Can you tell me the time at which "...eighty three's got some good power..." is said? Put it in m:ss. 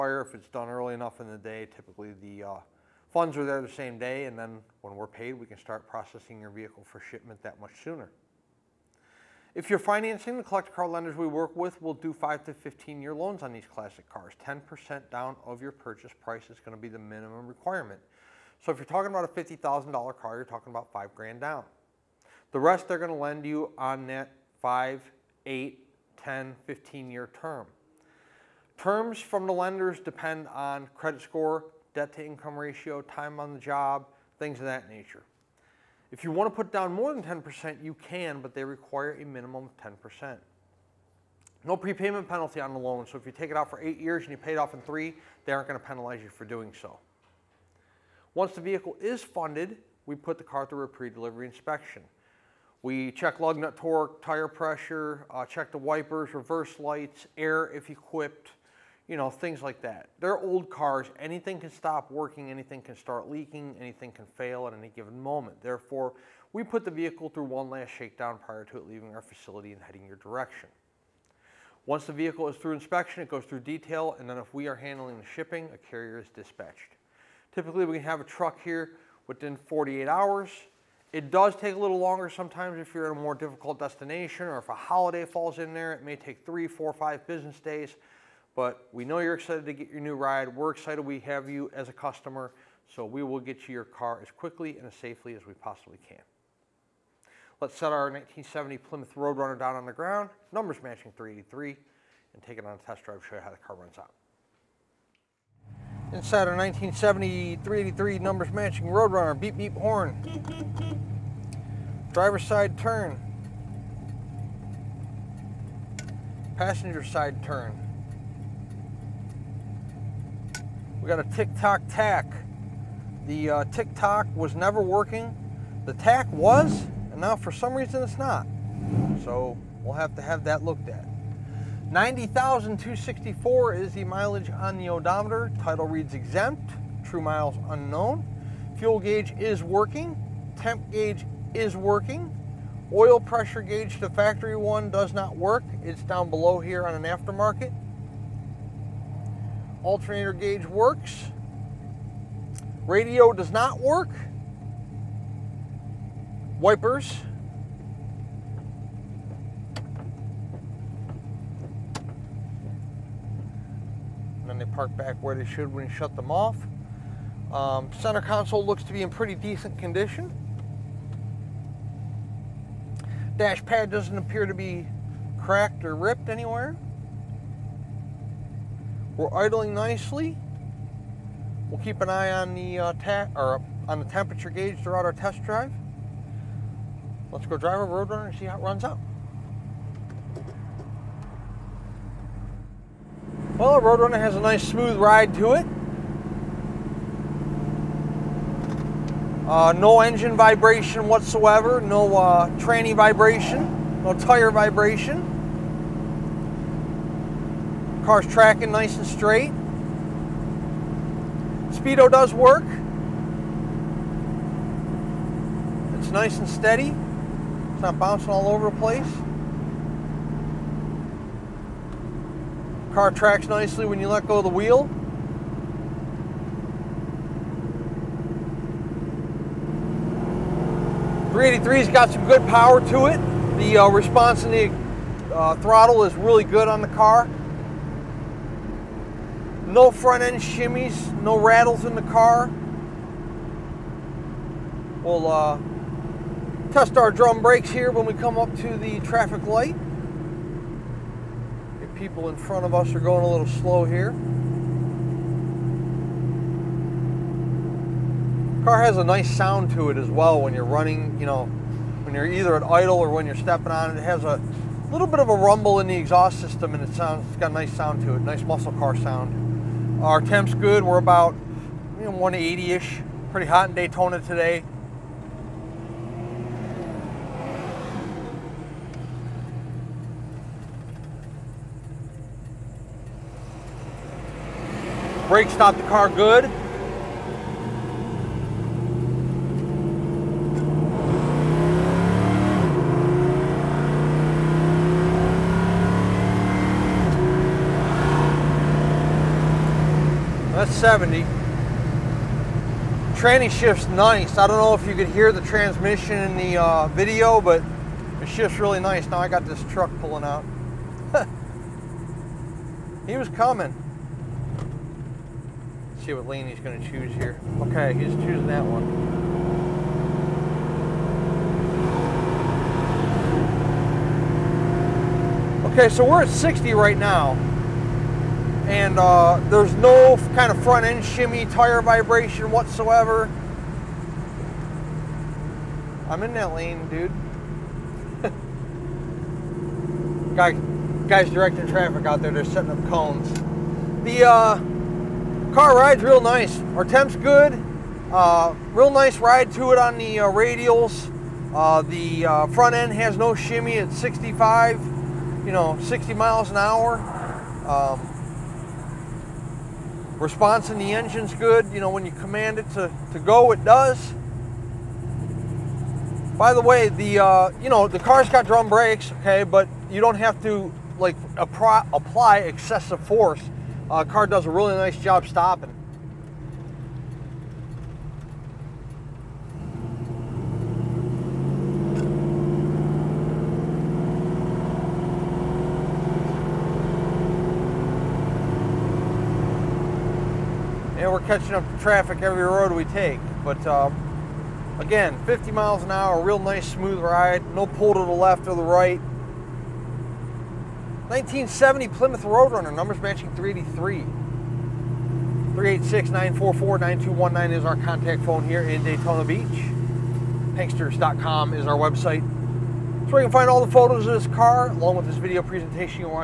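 3:51.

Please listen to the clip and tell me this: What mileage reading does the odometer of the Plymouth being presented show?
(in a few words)
90,264.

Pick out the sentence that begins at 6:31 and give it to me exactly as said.
And we're catching up to traffic every road we take.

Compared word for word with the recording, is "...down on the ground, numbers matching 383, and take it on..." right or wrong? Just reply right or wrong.
right.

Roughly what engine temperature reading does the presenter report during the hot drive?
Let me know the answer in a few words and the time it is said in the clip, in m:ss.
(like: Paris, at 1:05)
180, at 4:31.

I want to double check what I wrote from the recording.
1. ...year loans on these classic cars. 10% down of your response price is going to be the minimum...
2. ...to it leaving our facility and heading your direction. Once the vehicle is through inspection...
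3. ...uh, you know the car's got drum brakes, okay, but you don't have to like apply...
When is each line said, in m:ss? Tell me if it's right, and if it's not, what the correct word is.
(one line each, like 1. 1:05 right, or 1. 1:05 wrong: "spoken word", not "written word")
1. 0:13 wrong: "purchase", not "response"
2. 1:08 right
3. 6:07 right.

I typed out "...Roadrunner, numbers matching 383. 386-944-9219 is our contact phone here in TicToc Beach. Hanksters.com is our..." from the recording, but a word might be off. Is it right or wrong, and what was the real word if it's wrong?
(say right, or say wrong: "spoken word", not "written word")
wrong: "Daytona", not "TicToc".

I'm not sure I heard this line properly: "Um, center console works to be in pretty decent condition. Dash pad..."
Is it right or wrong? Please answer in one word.
wrong.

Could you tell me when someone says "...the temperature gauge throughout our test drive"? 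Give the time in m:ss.
3:03.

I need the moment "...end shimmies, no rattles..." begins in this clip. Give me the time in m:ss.
4:00.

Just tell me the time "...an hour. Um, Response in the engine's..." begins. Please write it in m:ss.
5:56.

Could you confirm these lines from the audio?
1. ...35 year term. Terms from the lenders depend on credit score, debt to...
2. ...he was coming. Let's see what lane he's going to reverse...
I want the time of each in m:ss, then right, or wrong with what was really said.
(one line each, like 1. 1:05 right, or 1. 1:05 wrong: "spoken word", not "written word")
1. 0:26 wrong: "15", not "35"
2. 5:13 wrong: "choose", not "reverse".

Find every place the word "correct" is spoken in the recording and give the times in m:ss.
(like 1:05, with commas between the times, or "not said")
not said.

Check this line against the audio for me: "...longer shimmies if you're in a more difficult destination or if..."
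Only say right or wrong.
wrong.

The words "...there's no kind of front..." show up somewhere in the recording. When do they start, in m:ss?
5:29.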